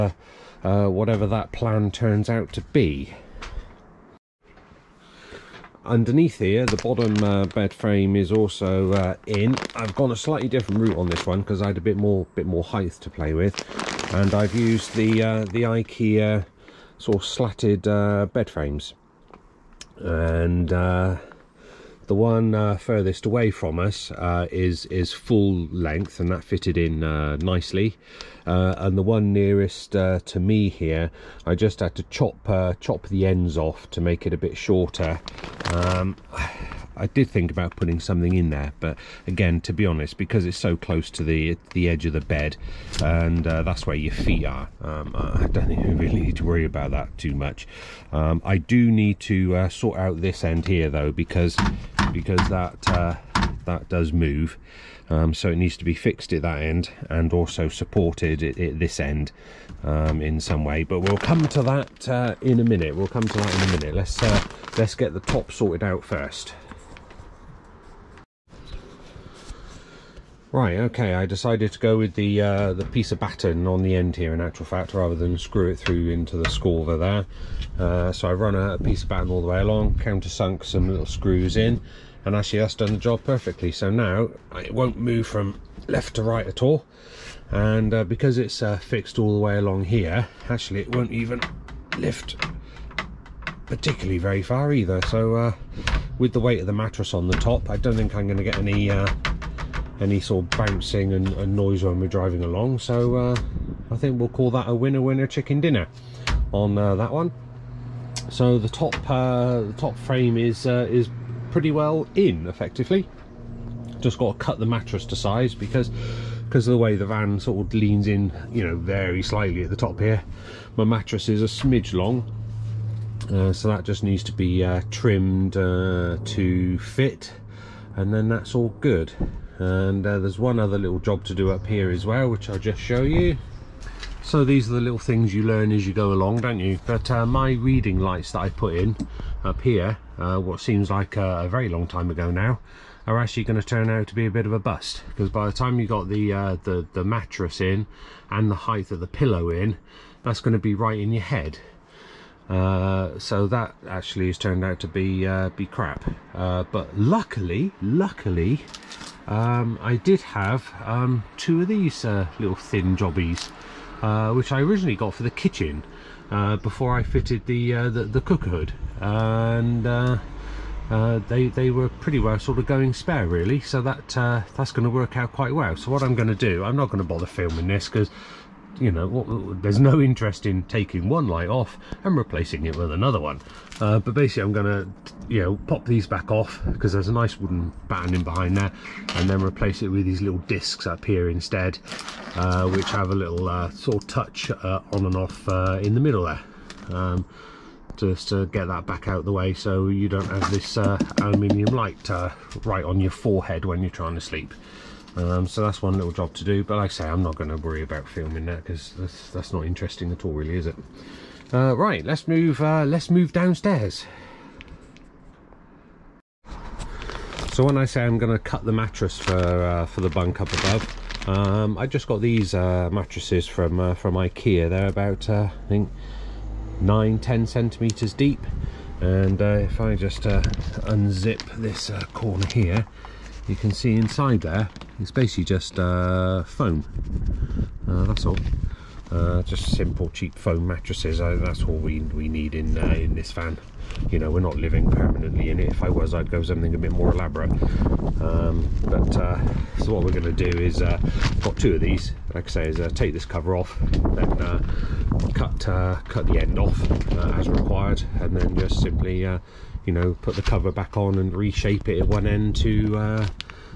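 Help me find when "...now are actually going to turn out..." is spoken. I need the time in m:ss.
2:22.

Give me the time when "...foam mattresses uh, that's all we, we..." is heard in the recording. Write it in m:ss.
4:00.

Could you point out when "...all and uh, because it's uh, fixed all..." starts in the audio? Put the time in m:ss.
1:26.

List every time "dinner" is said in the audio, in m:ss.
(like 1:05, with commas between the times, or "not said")
1:45.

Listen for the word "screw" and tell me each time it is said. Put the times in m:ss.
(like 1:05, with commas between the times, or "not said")
1:15, 1:21.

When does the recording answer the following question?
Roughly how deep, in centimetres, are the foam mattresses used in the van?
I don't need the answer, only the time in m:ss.
3:46.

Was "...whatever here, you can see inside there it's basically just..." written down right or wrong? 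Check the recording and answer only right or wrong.
wrong.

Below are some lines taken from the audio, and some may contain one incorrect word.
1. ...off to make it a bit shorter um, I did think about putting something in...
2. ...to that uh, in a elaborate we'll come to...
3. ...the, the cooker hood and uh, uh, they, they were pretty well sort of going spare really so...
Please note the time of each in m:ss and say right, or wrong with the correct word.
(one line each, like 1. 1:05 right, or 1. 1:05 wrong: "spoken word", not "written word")
1. 0:33 right
2. 1:01 wrong: "minute", not "elaborate"
3. 2:47 right.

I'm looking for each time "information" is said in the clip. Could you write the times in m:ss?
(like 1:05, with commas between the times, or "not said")
not said.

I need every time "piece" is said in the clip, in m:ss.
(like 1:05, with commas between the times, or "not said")
1:12, 1:18.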